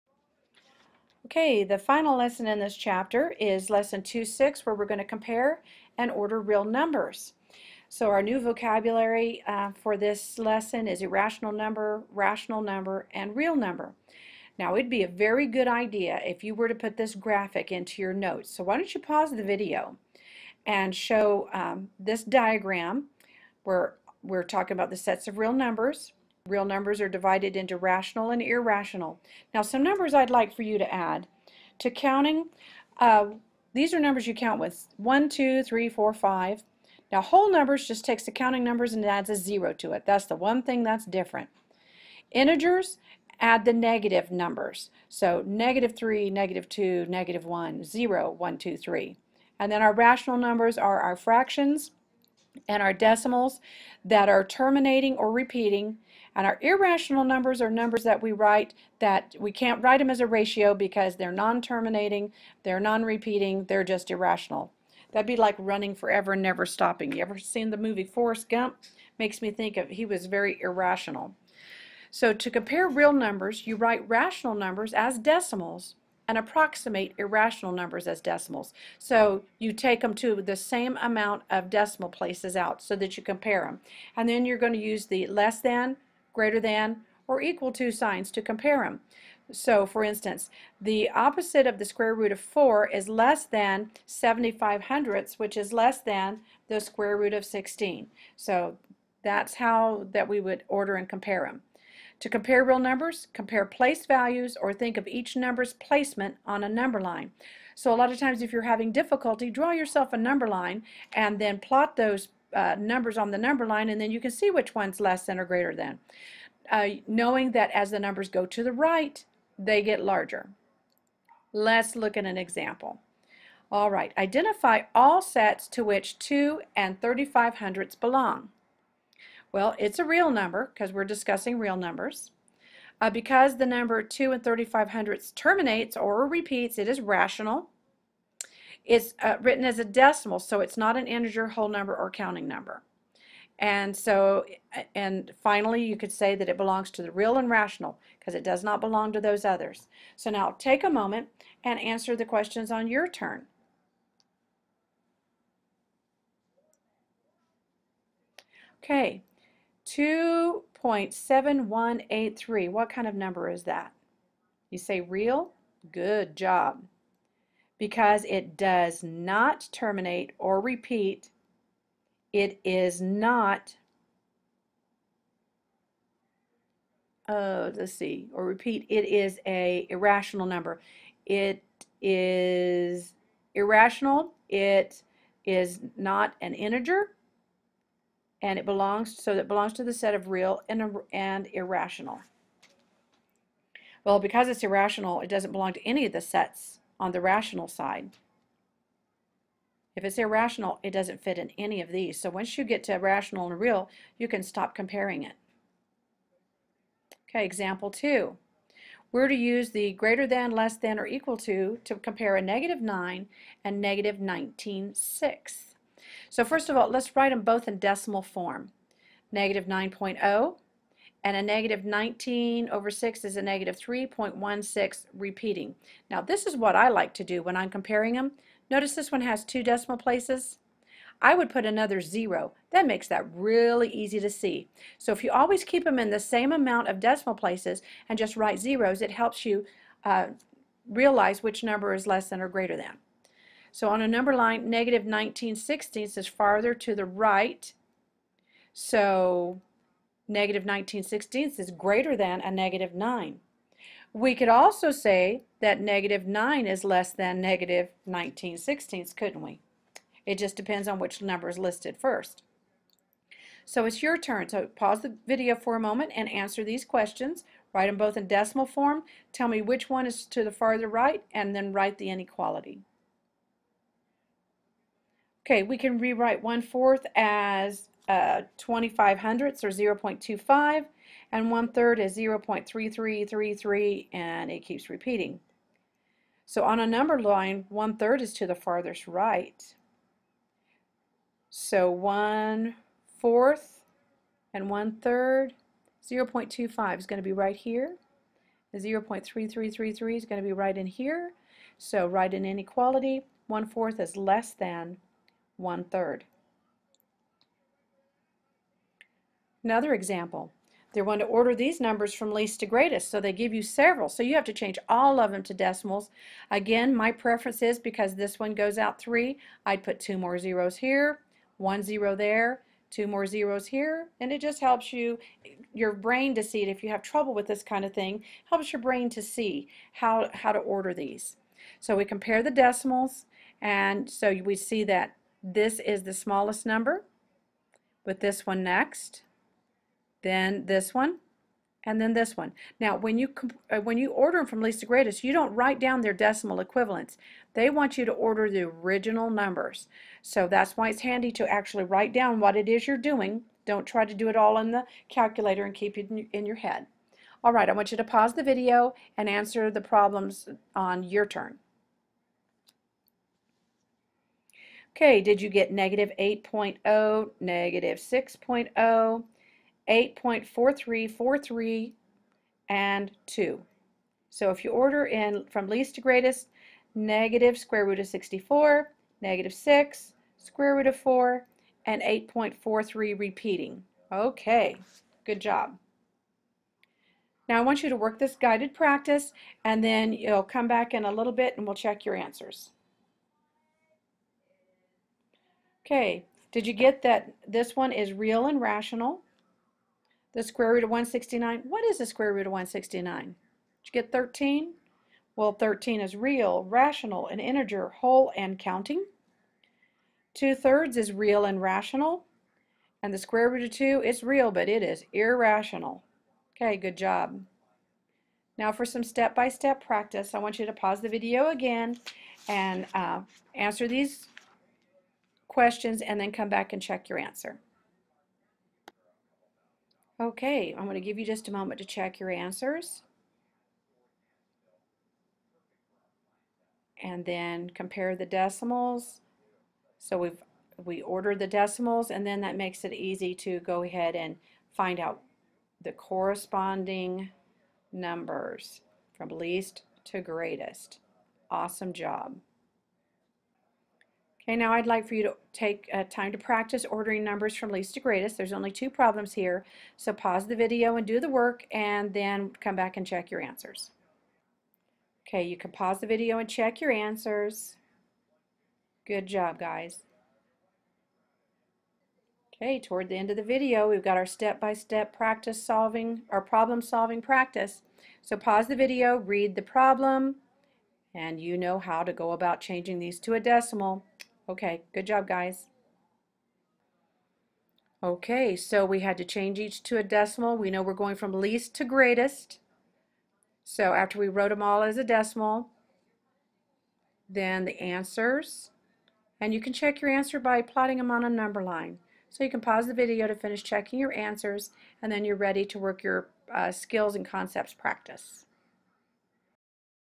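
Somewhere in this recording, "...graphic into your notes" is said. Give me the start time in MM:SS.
00:17.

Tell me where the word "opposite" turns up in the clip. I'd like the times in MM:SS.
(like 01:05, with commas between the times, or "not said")
01:31.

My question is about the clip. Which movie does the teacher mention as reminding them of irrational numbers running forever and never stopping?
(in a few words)
Forrest Gump.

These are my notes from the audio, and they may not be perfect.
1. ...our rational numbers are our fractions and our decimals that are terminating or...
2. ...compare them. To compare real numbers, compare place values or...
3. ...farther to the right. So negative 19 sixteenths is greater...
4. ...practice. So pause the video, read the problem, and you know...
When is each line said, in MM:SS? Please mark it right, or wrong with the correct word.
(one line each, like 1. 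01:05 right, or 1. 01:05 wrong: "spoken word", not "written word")
1. 00:49 right
2. 01:41 right
3. 04:06 right
4. 07:57 right.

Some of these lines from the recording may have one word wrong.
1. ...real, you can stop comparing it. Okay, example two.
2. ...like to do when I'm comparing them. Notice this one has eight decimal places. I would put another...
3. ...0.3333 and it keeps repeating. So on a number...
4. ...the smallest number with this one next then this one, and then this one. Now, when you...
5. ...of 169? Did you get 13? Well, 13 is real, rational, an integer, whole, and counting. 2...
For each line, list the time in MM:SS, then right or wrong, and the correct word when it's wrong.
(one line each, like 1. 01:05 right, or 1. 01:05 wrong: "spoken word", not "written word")
1. 03:23 right
2. 03:46 wrong: "two", not "eight"
3. 04:42 right
4. 05:36 right
5. 06:42 right.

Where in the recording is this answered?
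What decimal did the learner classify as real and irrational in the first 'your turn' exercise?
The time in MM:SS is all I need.
02:39.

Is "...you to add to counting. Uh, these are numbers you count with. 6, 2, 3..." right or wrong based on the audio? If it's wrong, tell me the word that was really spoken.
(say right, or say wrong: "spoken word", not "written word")
wrong: "1", not "6".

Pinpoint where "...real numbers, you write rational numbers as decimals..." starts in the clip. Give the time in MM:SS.
01:12.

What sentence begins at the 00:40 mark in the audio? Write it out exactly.
That's the one thing that's different.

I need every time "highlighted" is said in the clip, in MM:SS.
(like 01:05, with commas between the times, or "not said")
not said.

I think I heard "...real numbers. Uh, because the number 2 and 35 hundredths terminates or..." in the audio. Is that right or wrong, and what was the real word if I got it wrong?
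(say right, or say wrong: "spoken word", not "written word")
right.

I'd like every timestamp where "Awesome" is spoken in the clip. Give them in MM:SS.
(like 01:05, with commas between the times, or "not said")
07:31.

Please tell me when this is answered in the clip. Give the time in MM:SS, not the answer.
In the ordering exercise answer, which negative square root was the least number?
06:16.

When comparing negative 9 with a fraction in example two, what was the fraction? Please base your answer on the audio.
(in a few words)
-19/6.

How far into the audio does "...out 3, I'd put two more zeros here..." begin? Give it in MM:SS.
05:18.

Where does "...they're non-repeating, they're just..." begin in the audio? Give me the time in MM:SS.
01:02.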